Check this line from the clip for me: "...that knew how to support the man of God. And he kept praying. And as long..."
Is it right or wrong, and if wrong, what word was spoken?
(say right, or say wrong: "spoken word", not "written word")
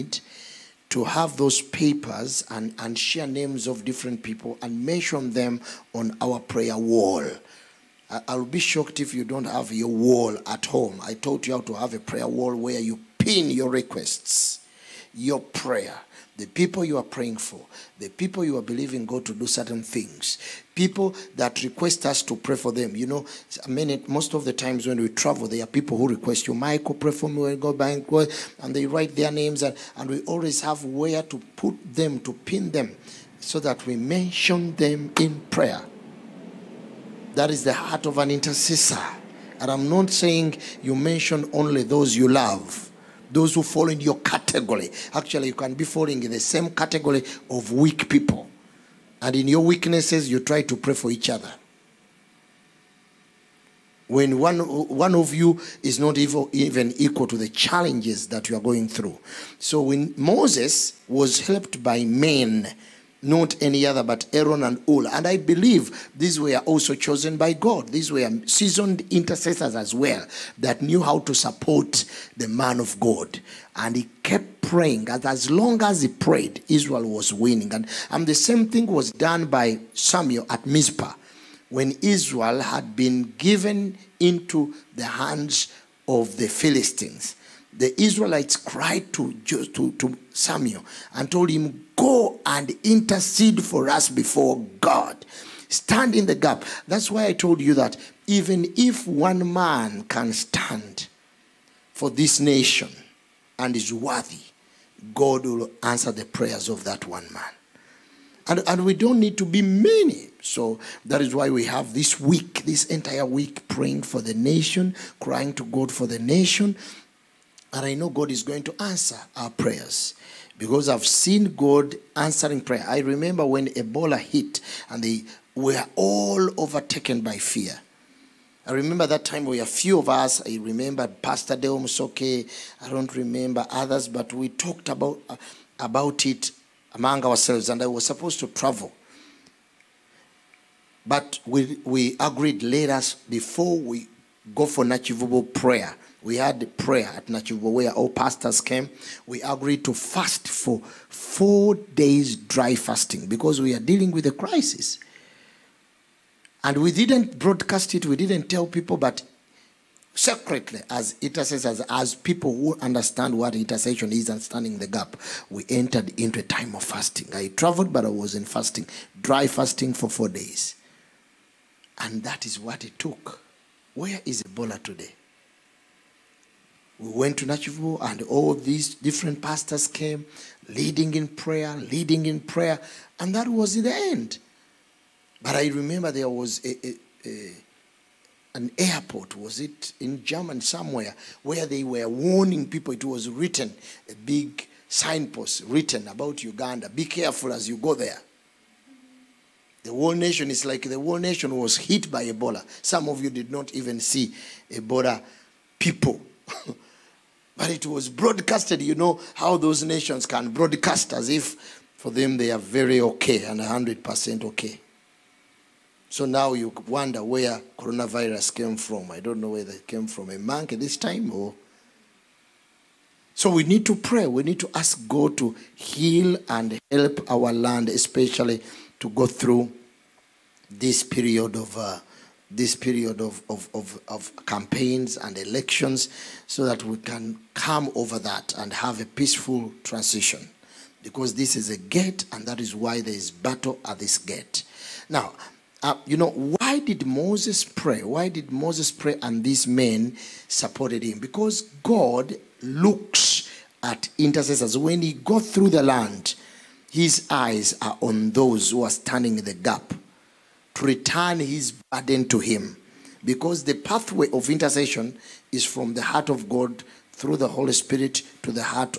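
right.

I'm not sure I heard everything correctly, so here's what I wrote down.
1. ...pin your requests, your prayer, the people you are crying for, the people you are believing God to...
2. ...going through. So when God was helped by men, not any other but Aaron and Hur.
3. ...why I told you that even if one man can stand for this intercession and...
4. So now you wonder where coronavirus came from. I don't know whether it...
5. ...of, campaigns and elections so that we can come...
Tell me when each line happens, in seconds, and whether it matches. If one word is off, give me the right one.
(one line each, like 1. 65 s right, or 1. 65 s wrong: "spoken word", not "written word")
1. 13 s wrong: "praying", not "crying"
2. 58 s wrong: "Moses", not "God"
3. 97 s wrong: "nation", not "intercession"
4. 216 s right
5. 234 s right.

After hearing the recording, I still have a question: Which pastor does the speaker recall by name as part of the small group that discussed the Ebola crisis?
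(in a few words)
Deo Musoke.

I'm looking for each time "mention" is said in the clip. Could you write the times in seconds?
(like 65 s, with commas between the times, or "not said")
4 s, 33 s, 40 s.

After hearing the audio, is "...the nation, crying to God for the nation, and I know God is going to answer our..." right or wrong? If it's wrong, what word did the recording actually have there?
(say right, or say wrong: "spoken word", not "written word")
right.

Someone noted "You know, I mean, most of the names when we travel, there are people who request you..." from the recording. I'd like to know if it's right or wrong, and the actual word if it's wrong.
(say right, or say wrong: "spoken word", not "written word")
wrong: "times", not "names".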